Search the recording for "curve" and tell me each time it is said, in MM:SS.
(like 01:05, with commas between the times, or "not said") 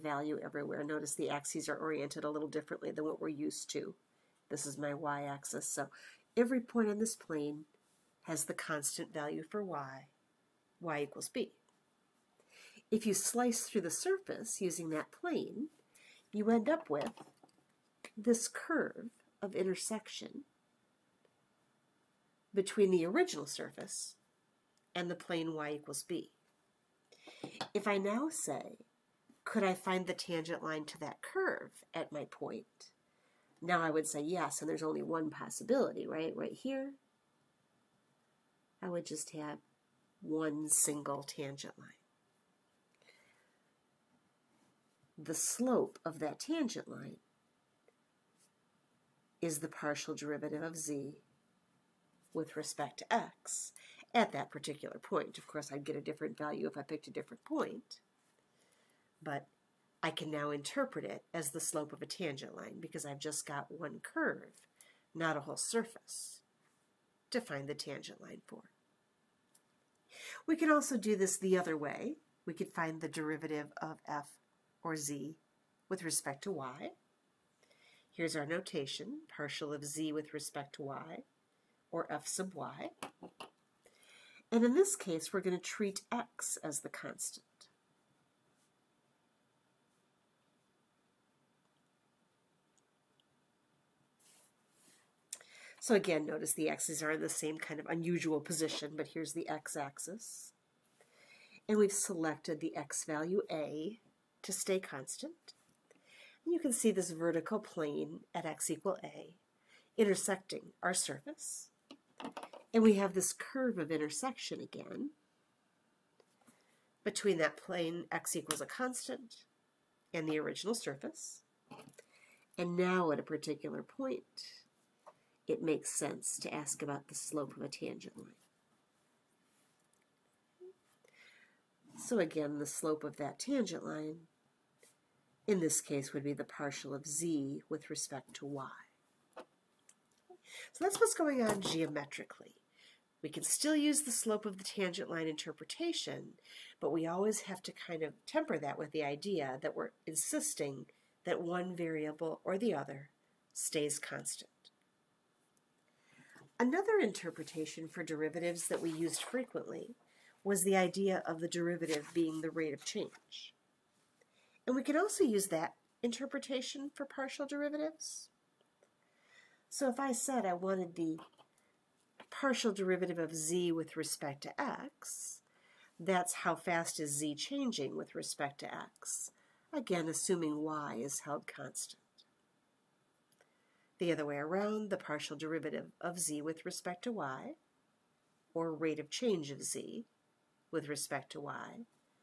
00:18, 00:31, 01:04, 01:53.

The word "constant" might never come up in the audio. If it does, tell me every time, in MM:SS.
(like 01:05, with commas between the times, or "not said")
00:08, 01:26, 01:44, 01:58, 02:33, 03:01.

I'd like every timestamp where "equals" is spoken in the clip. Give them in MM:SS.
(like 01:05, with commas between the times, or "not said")
00:11, 00:25, 01:48, 01:58.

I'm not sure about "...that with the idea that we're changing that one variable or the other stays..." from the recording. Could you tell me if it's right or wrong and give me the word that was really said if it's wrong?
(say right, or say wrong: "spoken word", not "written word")
wrong: "insisting", not "changing".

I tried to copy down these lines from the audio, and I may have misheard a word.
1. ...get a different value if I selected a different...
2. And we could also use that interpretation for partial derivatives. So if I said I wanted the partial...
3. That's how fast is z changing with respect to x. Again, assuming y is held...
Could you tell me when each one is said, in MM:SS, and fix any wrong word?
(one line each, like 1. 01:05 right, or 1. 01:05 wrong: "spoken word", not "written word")
1. 00:55 wrong: "picked", not "selected"
2. 02:44 right
3. 02:55 right.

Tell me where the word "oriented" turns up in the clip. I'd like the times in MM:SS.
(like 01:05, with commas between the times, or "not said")
00:01.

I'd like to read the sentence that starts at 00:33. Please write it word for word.
Now I would say yes, and there's only one possibility, right?